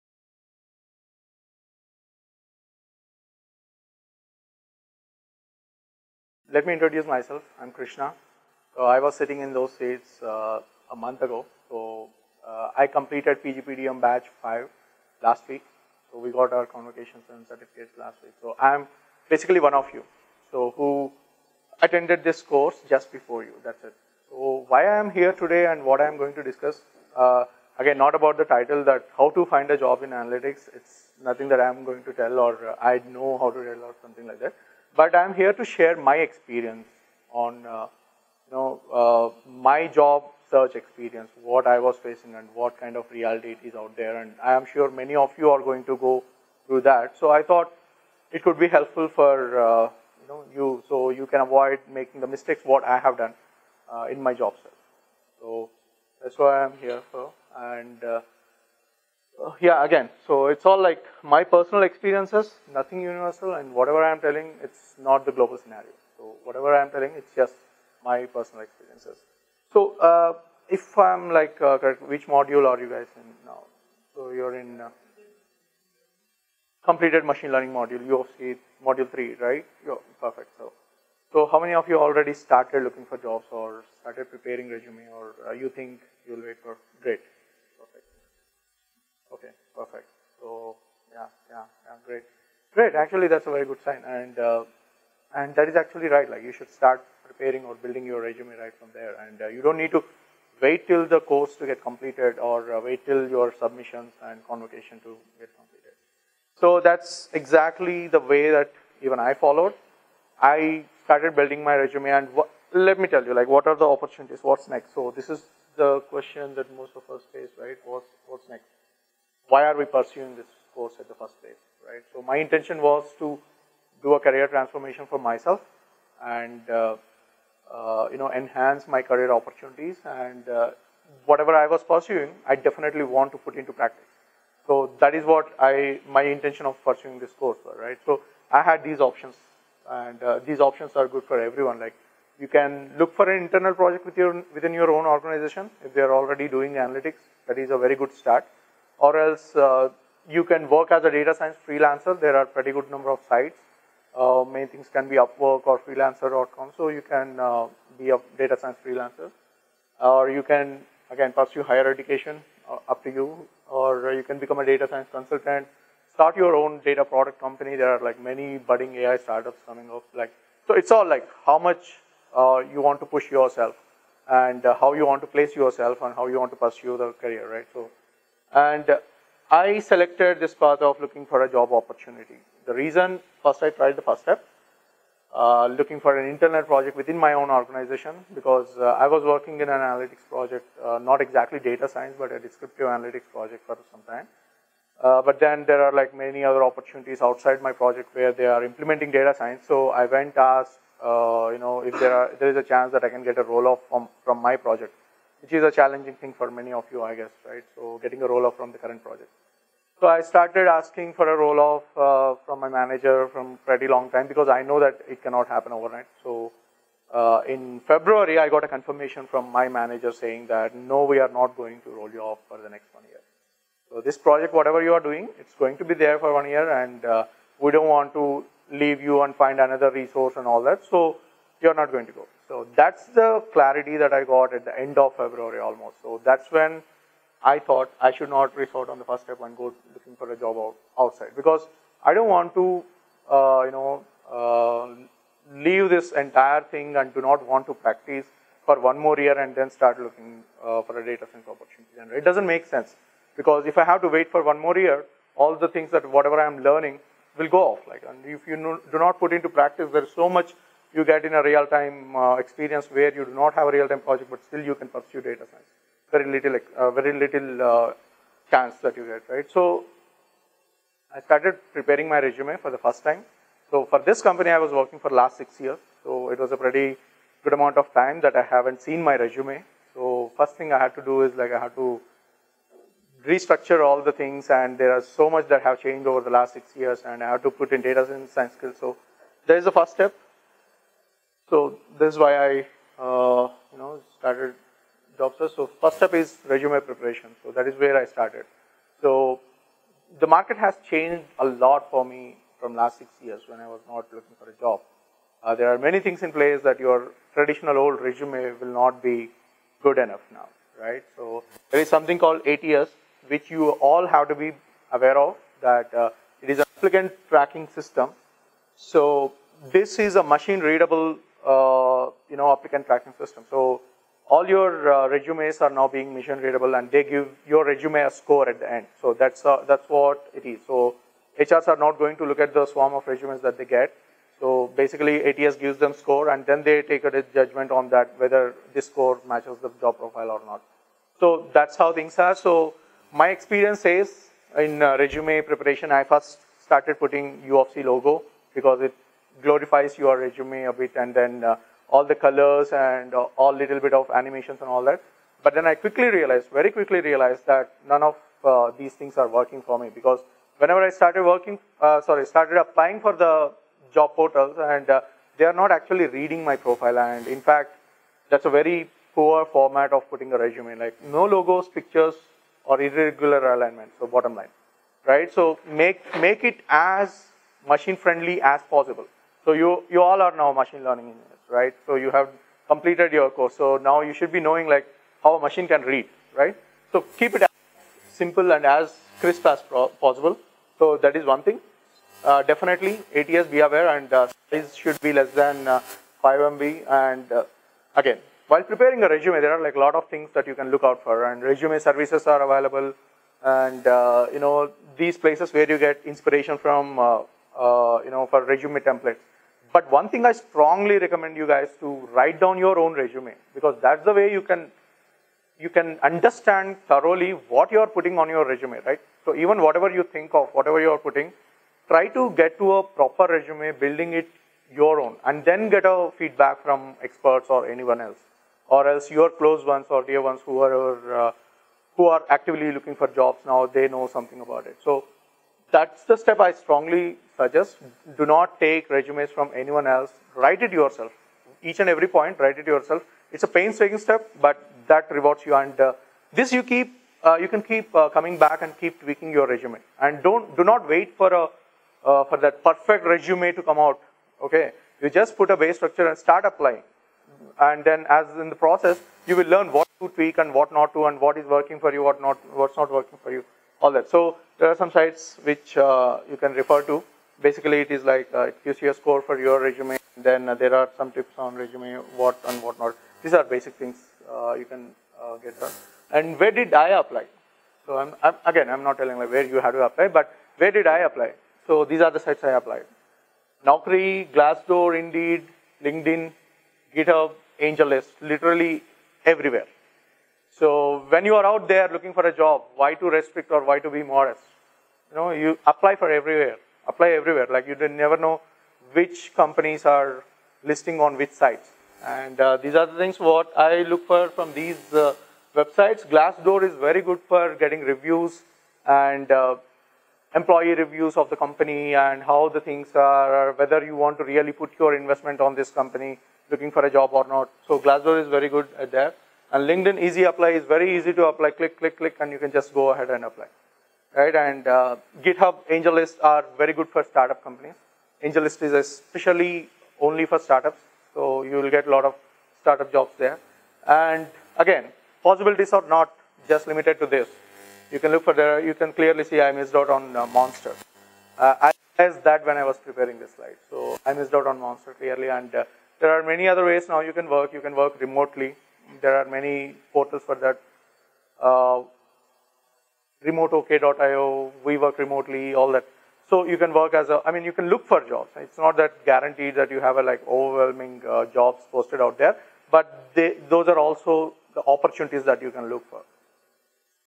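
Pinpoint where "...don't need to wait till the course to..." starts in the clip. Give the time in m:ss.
1:39.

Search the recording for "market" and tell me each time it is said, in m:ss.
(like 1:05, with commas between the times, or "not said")
5:00.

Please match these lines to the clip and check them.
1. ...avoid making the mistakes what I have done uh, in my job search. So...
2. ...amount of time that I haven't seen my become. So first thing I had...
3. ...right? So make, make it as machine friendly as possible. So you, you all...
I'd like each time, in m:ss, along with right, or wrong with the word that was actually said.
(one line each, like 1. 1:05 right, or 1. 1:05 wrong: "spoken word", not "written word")
1. 0:51 right
2. 4:37 wrong: "resume", not "become"
3. 6:15 right.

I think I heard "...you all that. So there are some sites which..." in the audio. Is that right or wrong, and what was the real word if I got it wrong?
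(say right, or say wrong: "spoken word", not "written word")
right.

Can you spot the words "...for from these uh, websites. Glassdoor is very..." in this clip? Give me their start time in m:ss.
8:24.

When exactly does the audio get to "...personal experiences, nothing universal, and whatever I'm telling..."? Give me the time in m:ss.
1:01.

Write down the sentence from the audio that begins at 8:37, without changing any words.
So Glassdoor is very good at that.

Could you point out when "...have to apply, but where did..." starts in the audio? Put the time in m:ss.
7:59.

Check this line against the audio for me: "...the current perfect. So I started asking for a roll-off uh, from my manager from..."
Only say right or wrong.
wrong.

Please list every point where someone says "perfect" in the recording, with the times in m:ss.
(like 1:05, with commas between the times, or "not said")
1:20, 7:32.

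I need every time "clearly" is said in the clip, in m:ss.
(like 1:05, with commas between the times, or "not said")
8:58, 9:04.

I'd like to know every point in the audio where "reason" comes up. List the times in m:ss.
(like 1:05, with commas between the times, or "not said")
3:02.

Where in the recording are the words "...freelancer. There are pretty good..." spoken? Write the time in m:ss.
2:31.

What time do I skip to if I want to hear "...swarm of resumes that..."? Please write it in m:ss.
5:32.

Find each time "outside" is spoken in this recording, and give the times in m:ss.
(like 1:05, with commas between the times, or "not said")
3:17, 4:00.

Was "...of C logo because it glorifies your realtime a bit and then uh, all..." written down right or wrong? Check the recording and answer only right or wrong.
wrong.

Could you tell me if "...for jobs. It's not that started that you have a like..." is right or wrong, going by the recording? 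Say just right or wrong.
wrong.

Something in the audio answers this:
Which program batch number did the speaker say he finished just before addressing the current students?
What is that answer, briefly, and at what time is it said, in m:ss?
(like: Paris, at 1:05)
5, at 0:13.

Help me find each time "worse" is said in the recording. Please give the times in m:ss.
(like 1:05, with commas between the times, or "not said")
not said.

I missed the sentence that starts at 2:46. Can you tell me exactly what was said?
Start your own data product company.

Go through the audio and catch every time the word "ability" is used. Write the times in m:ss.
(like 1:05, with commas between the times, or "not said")
not said.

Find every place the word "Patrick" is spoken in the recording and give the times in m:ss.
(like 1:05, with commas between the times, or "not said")
not said.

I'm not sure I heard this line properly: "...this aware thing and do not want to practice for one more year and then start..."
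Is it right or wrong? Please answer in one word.
wrong.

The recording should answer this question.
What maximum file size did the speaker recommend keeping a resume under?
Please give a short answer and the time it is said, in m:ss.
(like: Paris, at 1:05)
5 MB, at 6:35.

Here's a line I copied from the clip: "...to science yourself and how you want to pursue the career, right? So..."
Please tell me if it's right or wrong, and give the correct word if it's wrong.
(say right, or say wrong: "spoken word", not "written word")
wrong: "place", not "science".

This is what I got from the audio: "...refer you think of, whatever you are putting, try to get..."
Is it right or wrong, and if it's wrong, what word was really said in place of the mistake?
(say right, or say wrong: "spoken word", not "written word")
wrong: "whatever", not "refer".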